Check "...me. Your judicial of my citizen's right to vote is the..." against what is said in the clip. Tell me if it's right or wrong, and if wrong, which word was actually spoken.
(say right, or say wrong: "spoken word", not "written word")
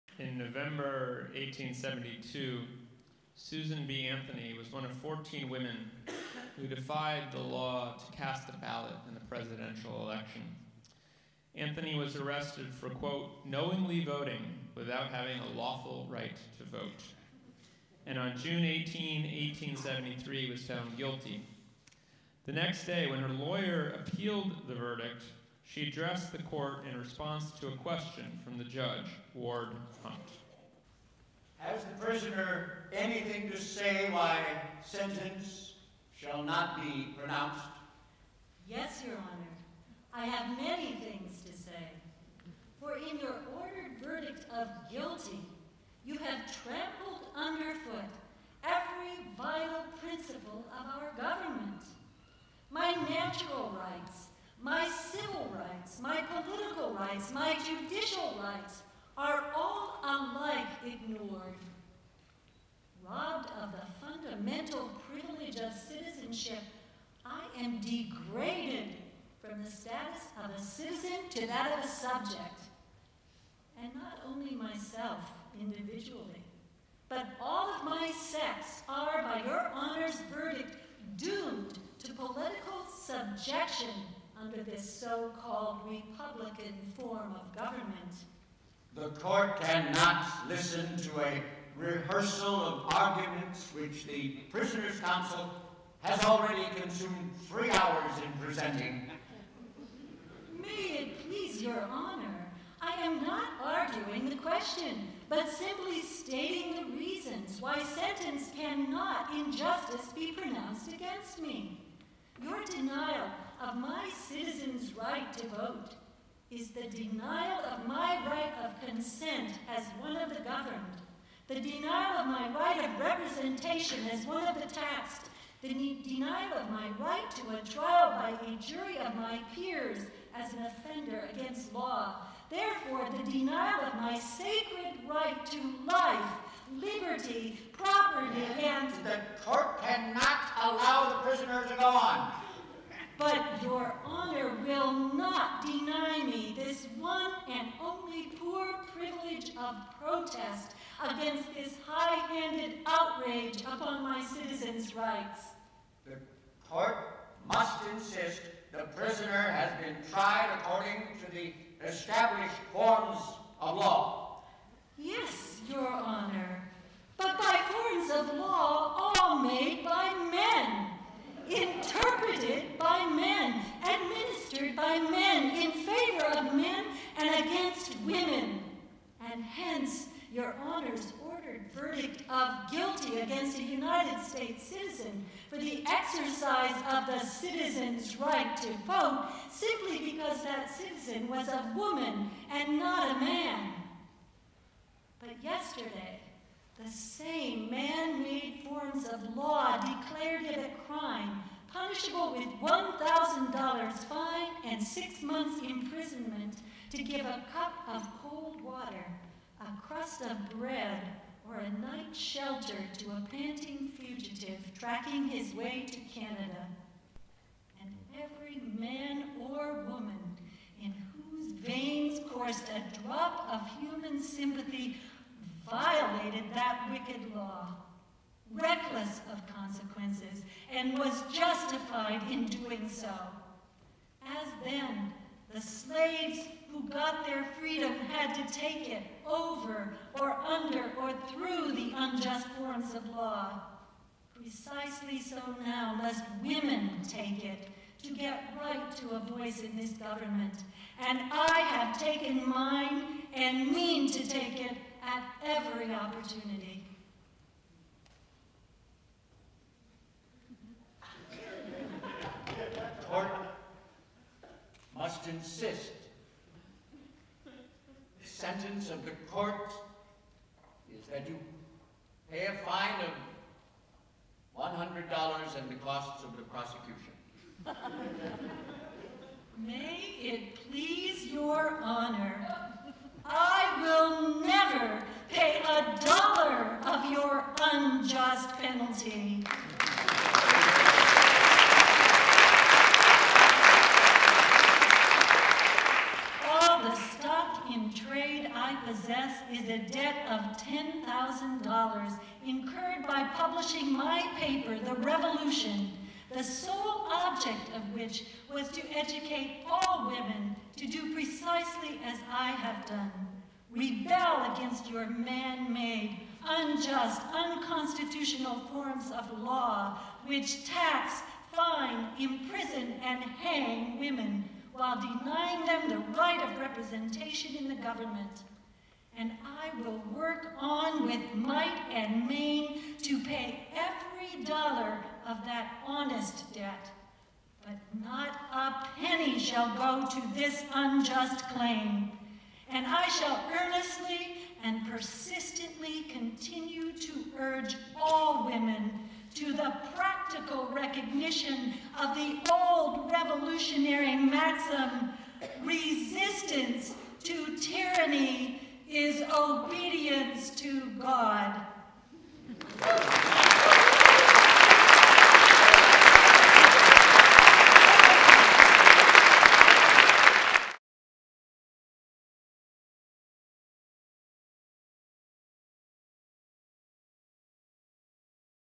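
wrong: "denial", not "judicial".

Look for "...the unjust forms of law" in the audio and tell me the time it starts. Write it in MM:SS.
04:01.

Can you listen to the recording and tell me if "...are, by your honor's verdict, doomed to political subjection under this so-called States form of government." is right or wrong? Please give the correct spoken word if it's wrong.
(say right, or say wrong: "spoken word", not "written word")
wrong: "Republican", not "States".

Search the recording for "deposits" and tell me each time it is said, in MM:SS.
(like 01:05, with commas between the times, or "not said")
not said.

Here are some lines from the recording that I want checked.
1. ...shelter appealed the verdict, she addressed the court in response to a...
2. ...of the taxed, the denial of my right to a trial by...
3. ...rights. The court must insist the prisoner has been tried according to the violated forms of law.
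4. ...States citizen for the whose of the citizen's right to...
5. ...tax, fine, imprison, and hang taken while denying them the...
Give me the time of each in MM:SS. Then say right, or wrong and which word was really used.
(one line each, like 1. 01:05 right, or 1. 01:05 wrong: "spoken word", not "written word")
1. 00:23 wrong: "lawyer", not "shelter"
2. 02:04 right
3. 02:34 wrong: "established", not "violated"
4. 03:04 wrong: "exercise", not "whose"
5. 05:20 wrong: "women", not "taken".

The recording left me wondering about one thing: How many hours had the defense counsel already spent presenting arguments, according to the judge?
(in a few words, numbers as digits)
3.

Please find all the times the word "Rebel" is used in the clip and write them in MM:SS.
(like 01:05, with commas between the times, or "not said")
05:13.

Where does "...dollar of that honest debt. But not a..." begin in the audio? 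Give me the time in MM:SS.
05:34.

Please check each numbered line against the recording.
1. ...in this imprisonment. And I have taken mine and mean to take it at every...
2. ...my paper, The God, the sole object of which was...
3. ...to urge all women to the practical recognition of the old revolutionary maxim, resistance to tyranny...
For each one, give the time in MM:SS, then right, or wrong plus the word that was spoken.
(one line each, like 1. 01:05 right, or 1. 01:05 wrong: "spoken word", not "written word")
1. 04:09 wrong: "government", not "imprisonment"
2. 05:03 wrong: "Revolution", not "God"
3. 05:46 right.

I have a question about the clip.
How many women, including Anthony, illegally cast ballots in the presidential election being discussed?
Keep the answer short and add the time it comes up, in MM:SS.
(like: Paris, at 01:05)
14, at 00:04.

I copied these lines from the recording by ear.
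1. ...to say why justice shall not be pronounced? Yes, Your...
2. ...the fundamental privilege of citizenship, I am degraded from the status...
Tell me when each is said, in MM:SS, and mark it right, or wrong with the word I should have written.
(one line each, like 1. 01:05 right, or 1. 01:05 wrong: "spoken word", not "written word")
1. 00:33 wrong: "sentence", not "justice"
2. 01:03 right.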